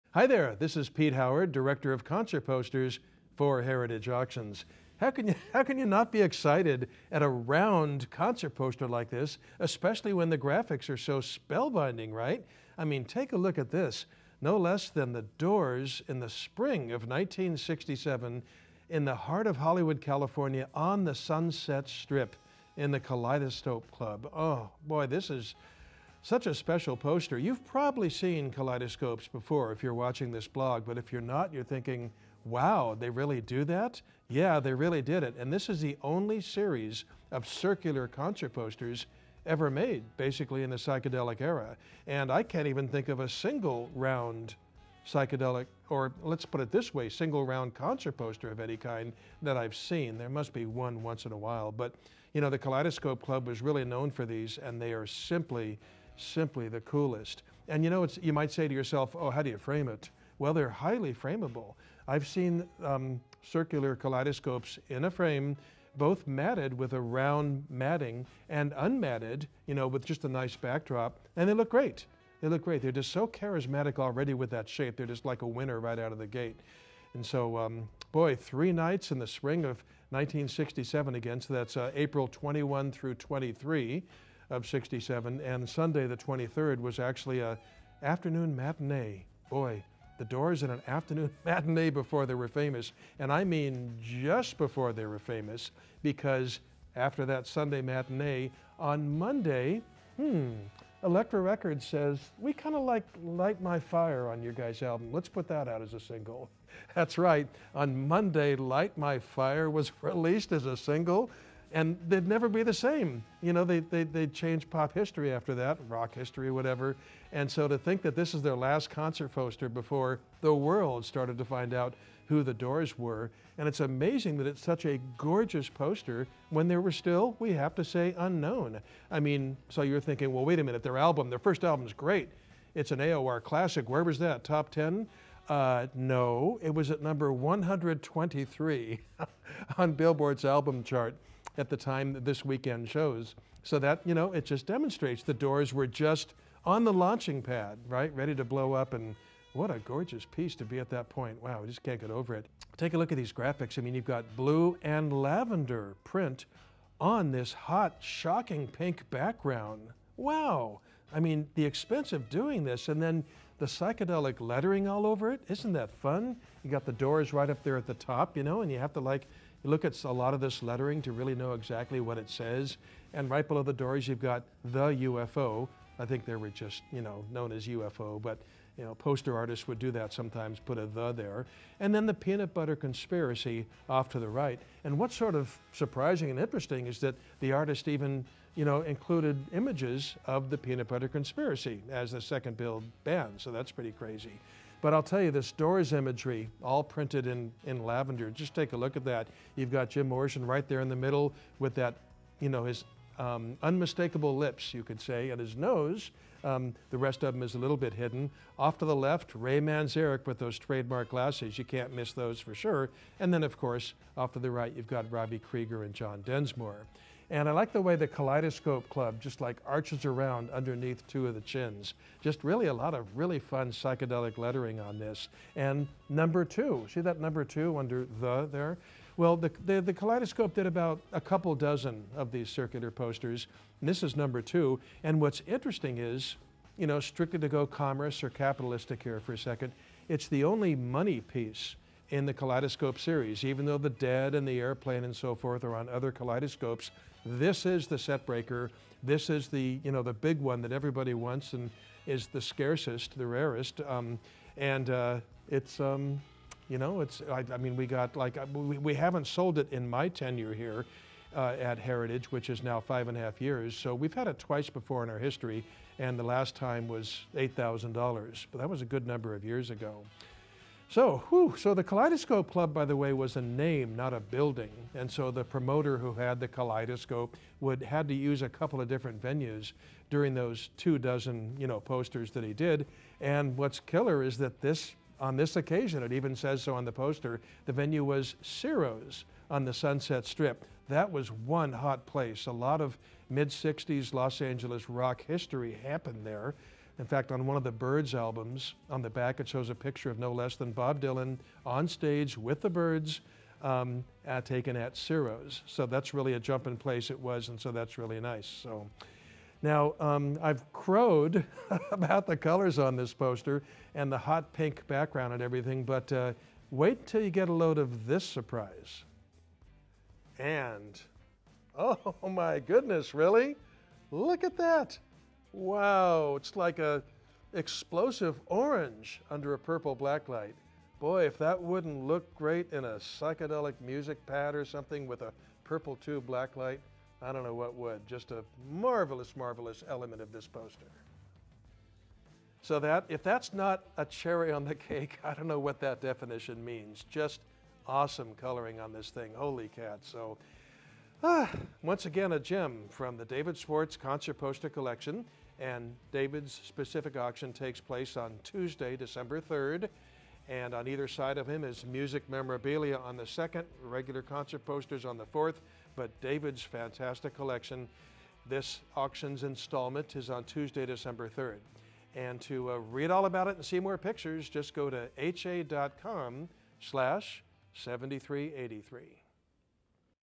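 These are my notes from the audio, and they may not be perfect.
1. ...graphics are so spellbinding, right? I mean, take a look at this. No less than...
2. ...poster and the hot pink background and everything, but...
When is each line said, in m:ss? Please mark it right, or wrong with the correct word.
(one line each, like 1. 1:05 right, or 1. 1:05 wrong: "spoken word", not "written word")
1. 0:10 right
2. 5:13 right.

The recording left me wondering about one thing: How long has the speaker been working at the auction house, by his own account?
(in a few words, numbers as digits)
5 and a half years.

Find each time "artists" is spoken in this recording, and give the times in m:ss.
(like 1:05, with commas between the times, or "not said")
2:59, 3:07.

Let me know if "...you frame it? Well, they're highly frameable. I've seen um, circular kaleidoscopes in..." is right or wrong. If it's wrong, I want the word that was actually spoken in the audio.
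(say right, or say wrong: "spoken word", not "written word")
right.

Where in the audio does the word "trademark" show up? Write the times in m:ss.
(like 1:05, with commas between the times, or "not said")
3:30.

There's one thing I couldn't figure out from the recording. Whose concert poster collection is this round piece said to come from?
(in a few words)
David Schwartz.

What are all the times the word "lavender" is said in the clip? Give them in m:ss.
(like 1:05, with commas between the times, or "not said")
2:35, 3:17.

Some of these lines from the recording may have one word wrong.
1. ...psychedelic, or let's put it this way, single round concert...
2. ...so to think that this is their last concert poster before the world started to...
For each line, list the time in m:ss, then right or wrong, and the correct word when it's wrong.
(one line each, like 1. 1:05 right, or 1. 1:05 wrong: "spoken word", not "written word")
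1. 0:45 right
2. 1:57 right.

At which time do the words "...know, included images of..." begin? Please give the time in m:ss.
3:08.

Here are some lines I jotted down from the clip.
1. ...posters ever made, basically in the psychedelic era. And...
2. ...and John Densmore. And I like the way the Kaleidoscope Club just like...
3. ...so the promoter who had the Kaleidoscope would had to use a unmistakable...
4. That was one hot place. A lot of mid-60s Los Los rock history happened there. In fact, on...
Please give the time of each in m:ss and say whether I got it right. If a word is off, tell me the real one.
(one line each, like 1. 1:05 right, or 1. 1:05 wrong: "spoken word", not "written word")
1. 0:38 right
2. 3:35 right
3. 4:35 wrong: "couple", not "unmistakable"
4. 4:50 wrong: "Angeles", not "Los".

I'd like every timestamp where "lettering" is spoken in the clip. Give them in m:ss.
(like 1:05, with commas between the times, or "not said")
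2:44, 2:50, 3:44.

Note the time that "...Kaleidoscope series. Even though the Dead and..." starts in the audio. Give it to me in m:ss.
4:02.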